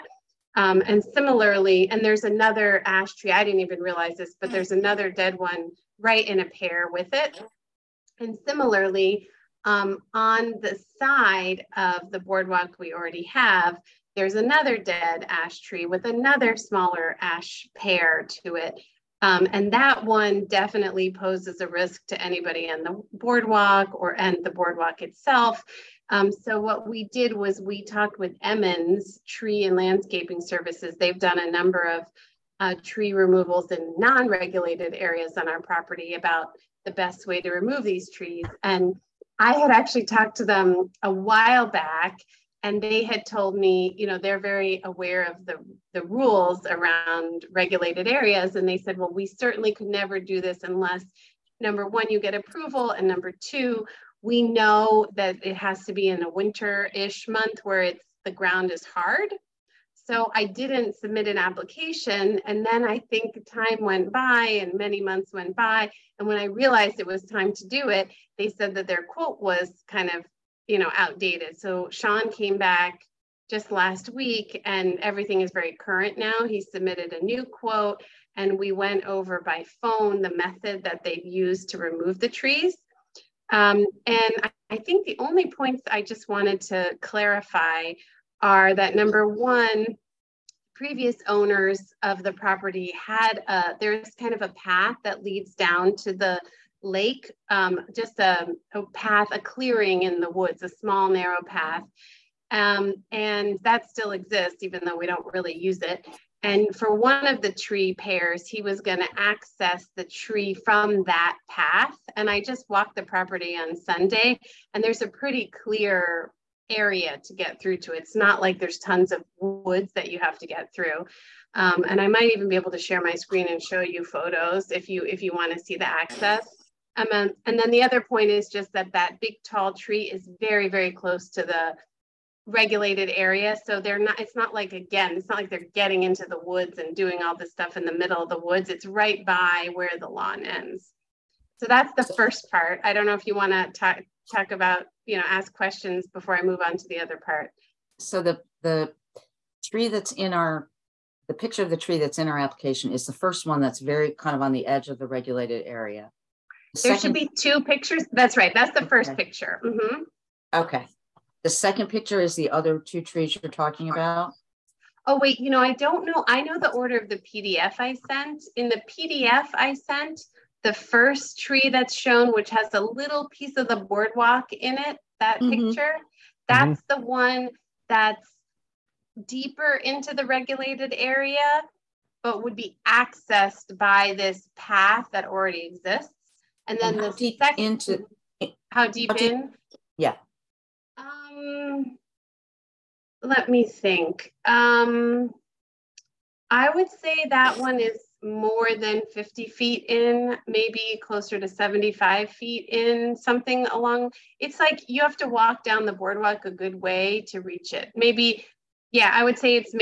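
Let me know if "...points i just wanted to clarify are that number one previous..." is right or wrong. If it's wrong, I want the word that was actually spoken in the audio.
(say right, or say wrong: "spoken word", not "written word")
right.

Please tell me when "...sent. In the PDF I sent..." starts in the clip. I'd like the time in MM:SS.
02:48.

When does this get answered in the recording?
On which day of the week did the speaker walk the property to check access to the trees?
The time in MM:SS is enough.
01:53.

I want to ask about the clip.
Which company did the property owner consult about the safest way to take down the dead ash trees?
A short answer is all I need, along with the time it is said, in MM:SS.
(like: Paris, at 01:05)
Emmons Tree and Landscaping Services, at 00:28.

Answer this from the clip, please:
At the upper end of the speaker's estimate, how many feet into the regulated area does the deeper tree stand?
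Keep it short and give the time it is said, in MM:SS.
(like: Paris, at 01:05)
75 feet, at 03:21.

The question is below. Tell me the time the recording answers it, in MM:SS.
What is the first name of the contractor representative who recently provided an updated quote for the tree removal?
01:11.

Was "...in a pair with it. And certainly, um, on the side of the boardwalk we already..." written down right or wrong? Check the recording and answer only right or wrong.
wrong.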